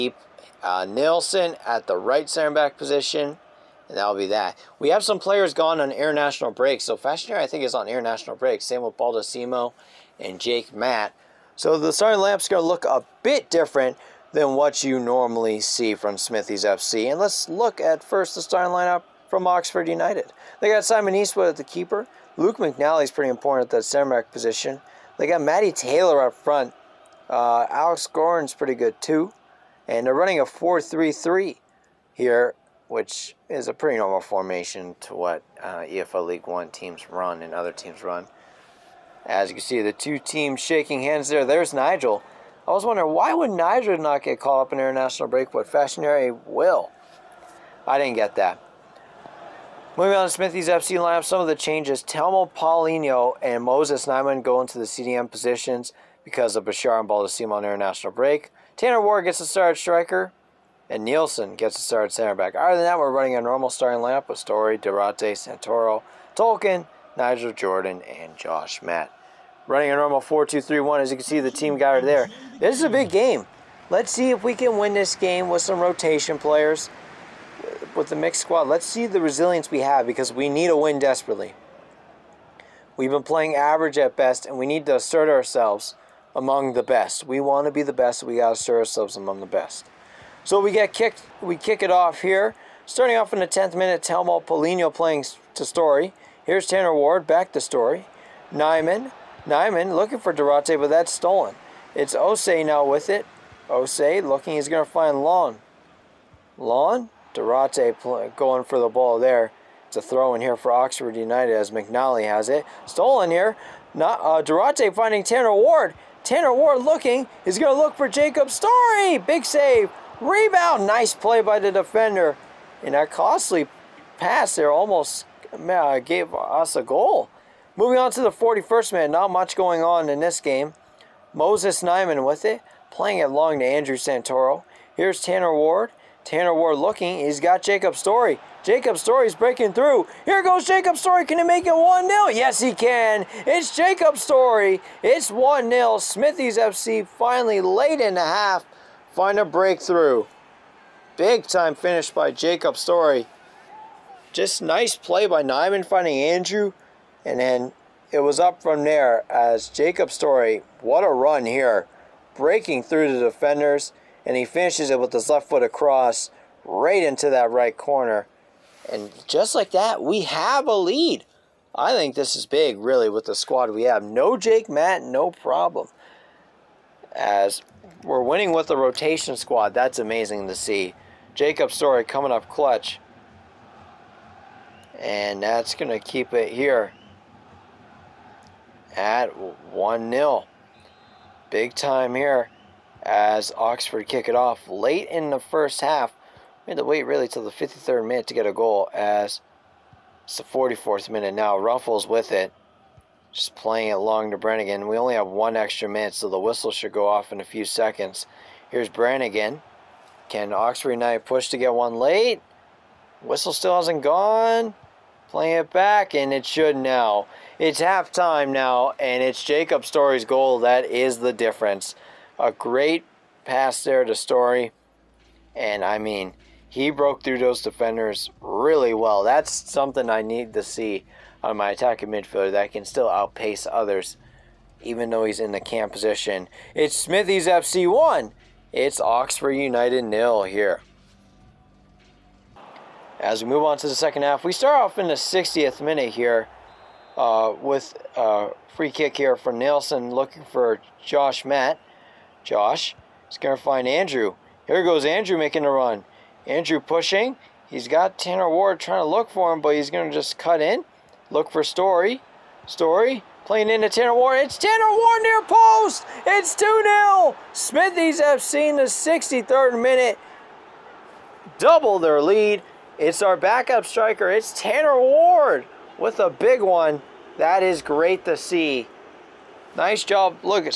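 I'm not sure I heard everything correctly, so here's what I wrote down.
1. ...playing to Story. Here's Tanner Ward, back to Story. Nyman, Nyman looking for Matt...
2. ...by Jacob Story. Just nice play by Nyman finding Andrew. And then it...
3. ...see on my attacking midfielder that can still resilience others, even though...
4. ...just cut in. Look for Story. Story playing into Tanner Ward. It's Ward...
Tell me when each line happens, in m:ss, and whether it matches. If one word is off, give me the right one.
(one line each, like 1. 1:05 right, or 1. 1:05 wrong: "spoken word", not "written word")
1. 1:34 wrong: "Durate", not "Matt"
2. 2:32 right
3. 3:50 wrong: "outpace", not "resilience"
4. 4:20 wrong: "Tanner", not "Ward".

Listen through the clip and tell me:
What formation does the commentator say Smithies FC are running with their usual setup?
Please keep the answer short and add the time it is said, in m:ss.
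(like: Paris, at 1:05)
4-2-3-1, at 1:10.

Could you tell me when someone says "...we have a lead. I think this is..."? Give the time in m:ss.
2:50.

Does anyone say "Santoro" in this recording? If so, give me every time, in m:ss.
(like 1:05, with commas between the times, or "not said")
1:05, 2:13.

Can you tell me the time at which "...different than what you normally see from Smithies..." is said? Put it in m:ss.
0:13.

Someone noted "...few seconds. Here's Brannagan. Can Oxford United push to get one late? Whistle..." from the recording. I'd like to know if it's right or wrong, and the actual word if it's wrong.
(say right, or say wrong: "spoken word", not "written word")
right.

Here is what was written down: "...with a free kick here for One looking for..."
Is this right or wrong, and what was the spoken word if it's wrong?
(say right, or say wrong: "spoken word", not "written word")
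wrong: "Nielsen", not "One".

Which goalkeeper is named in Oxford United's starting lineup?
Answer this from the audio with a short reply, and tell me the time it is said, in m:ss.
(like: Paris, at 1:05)
Simon Eastwood, at 0:20.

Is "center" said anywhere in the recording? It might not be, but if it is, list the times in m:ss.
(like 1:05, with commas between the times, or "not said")
0:02, 0:23, 1:02.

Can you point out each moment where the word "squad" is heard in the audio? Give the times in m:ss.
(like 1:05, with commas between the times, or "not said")
1:18, 2:53, 2:59.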